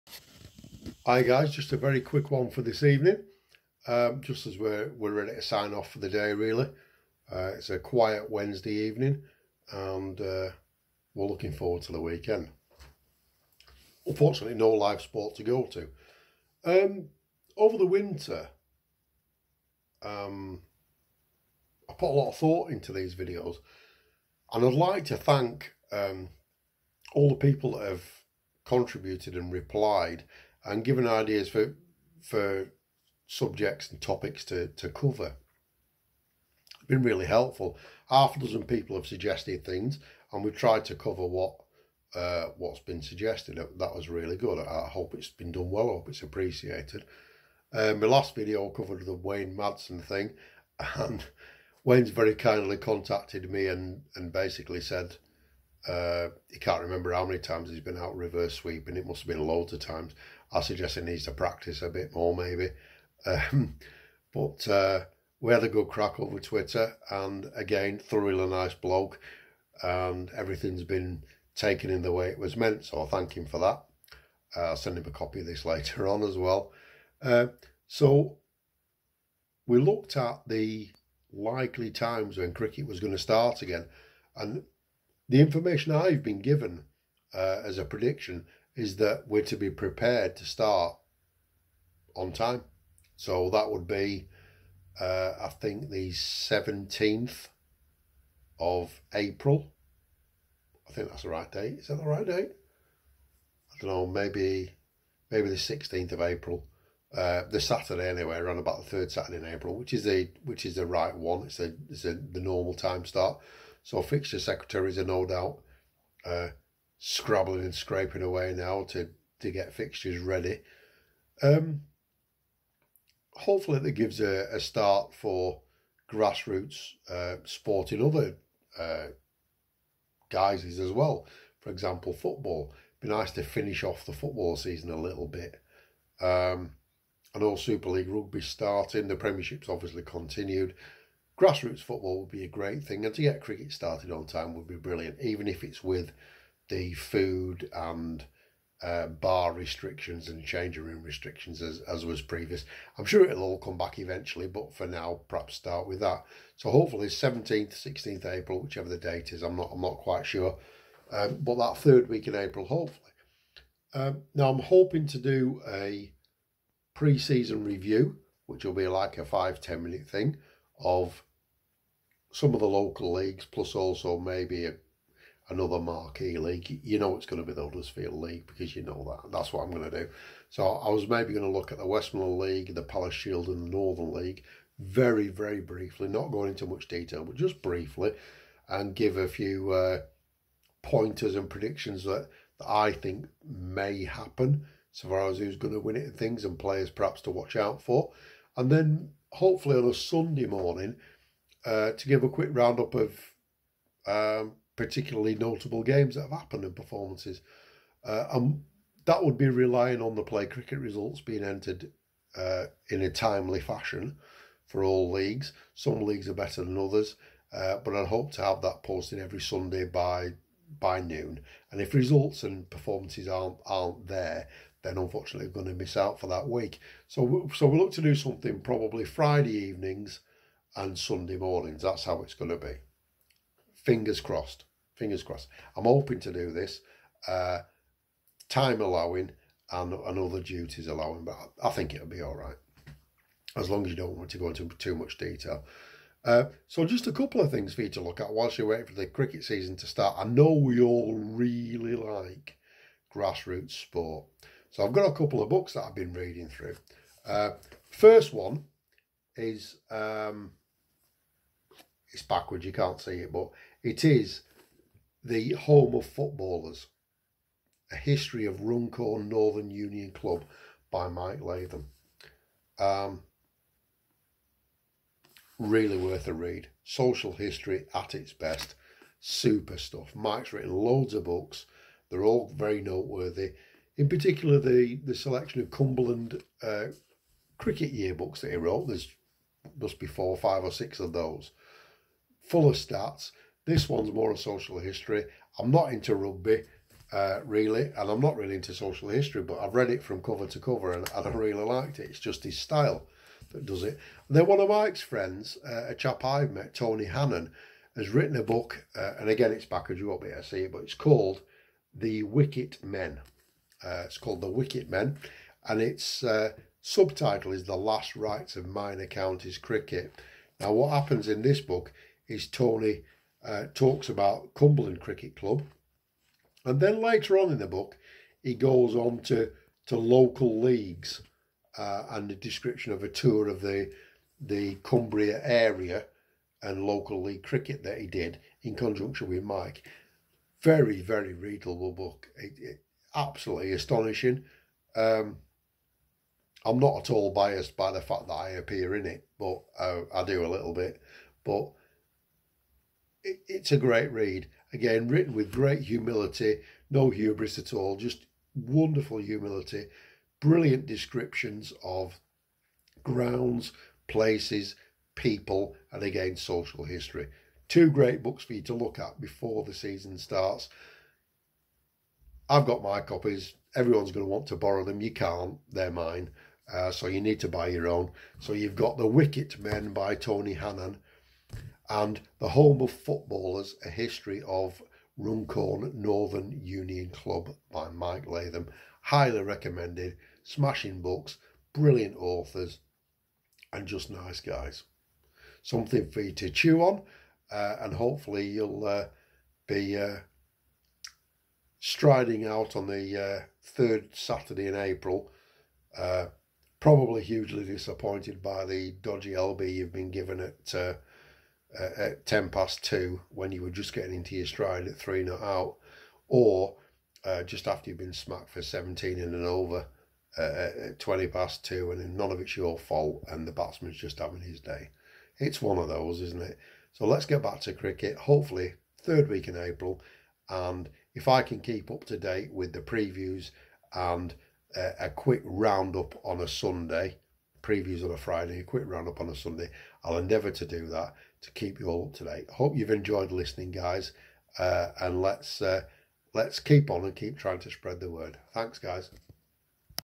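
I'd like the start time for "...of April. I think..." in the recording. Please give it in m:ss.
1:38.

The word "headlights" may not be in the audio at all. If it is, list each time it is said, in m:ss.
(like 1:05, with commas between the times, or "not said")
not said.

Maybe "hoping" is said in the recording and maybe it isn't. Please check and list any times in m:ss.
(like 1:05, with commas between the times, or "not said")
2:44, 3:55.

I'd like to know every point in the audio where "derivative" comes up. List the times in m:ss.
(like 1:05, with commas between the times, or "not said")
not said.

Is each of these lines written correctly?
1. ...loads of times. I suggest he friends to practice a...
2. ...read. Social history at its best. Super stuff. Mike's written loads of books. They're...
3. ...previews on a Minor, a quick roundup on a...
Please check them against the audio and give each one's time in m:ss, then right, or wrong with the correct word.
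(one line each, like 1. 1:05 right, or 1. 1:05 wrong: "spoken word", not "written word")
1. 0:59 wrong: "needs", not "friends"
2. 4:36 right
3. 7:17 wrong: "Friday", not "Minor".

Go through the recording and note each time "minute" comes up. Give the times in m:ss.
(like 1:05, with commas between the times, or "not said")
2:49.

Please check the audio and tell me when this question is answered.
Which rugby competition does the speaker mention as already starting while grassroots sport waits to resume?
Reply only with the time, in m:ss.
2:17.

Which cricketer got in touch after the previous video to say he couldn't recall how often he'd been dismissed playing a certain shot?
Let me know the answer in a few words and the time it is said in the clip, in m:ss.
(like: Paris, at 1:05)
Wayne Madsen, at 0:49.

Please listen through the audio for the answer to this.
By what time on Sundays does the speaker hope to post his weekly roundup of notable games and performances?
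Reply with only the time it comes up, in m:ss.
3:41.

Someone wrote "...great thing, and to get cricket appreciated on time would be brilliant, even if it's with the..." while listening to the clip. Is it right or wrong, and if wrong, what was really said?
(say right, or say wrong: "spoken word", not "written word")
wrong: "started", not "appreciated".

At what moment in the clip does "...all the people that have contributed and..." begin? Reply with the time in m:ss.
0:27.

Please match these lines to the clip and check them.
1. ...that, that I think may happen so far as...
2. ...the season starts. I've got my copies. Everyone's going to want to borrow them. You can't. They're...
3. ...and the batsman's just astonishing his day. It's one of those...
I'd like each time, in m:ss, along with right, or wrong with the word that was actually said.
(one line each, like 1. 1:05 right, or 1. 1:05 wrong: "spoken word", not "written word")
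1. 3:12 right
2. 6:09 right
3. 7:03 wrong: "having", not "astonishing".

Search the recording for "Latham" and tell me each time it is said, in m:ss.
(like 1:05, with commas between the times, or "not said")
4:31, 6:28.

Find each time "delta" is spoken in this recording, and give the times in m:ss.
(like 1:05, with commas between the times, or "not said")
not said.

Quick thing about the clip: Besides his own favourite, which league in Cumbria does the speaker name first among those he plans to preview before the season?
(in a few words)
Westmorland League.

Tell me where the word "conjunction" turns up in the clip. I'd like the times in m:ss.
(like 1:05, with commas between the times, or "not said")
5:38.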